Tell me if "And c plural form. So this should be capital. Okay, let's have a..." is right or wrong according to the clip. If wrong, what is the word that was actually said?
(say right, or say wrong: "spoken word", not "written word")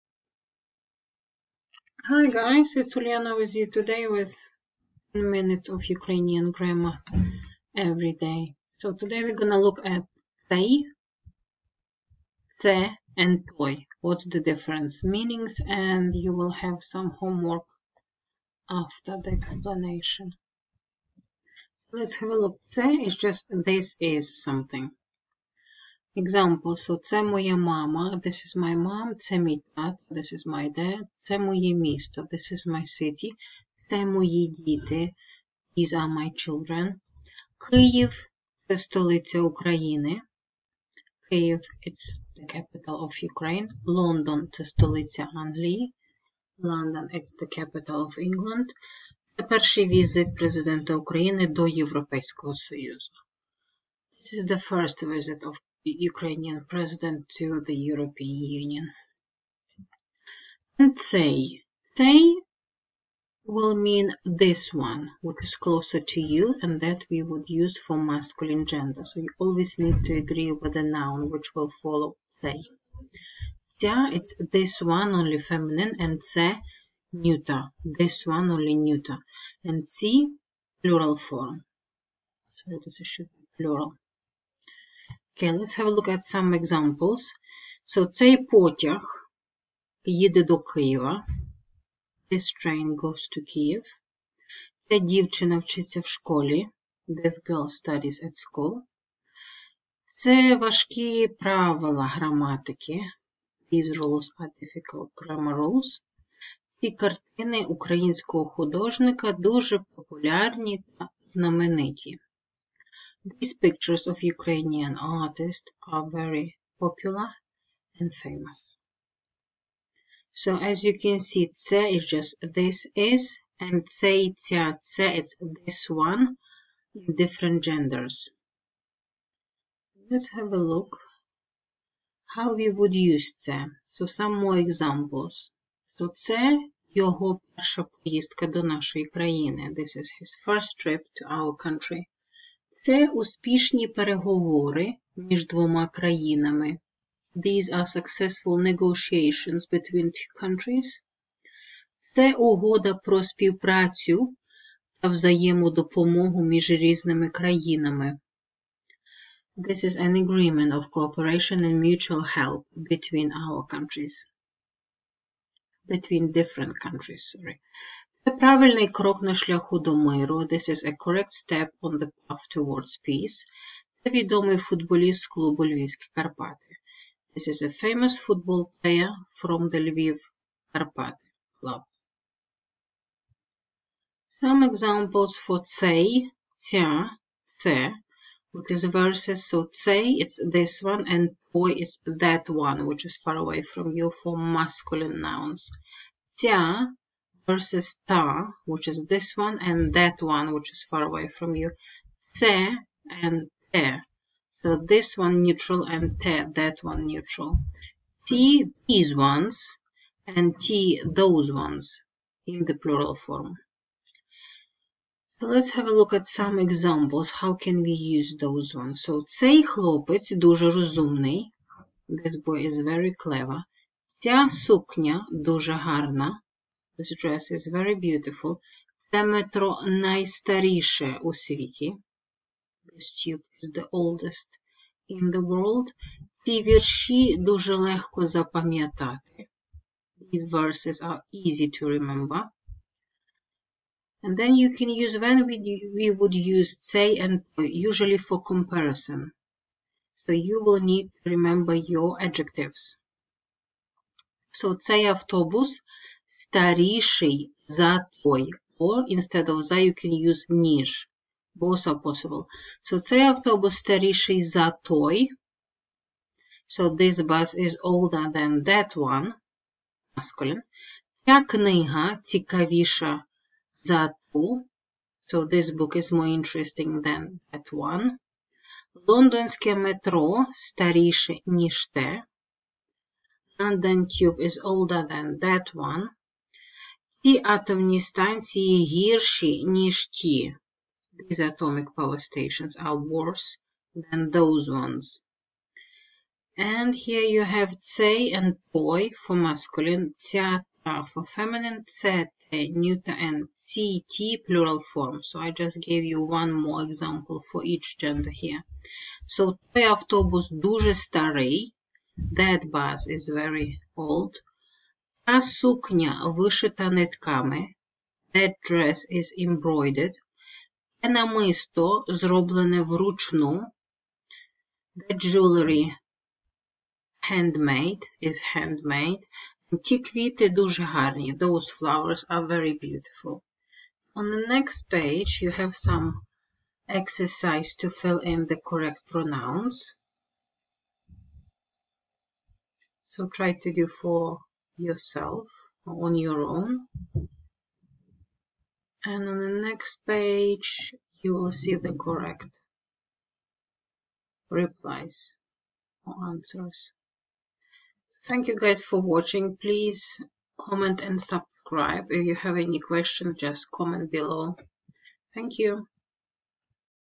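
wrong: "plural", not "capital".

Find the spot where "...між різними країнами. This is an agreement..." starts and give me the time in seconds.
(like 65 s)
156 s.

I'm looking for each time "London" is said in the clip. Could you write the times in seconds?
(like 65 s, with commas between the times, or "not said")
46 s, 283 s.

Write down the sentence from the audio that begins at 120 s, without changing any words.
So as you can see, це is just this is, and цей, ця, це it's this one in different genders.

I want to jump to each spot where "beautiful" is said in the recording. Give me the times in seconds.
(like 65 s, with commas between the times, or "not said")
228 s, 332 s.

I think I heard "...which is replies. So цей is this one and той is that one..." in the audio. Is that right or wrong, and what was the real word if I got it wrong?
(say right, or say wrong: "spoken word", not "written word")
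wrong: "verses", not "replies".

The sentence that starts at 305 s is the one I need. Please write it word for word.
So I just gave you one more example for each gender here.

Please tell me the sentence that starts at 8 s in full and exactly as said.
So today we're gonna look at they, te, and toy.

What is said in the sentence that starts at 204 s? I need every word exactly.
So this one neutral and te, that one neutral.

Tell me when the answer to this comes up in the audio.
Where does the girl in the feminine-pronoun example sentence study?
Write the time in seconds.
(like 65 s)
95 s.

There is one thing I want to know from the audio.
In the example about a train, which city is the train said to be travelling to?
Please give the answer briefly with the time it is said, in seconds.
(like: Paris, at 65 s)
Kyiv, at 90 s.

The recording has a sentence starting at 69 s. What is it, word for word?
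So you always need to agree with the noun which will follow say.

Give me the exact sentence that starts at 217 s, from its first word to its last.
How can we use those ones?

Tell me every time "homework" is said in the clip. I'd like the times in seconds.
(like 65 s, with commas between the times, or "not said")
17 s.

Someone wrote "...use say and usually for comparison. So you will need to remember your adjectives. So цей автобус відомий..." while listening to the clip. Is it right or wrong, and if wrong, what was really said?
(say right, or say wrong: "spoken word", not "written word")
wrong: "старіший", not "відомий".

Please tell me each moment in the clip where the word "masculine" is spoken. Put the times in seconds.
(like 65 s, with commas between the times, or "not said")
67 s, 194 s, 270 s, 299 s.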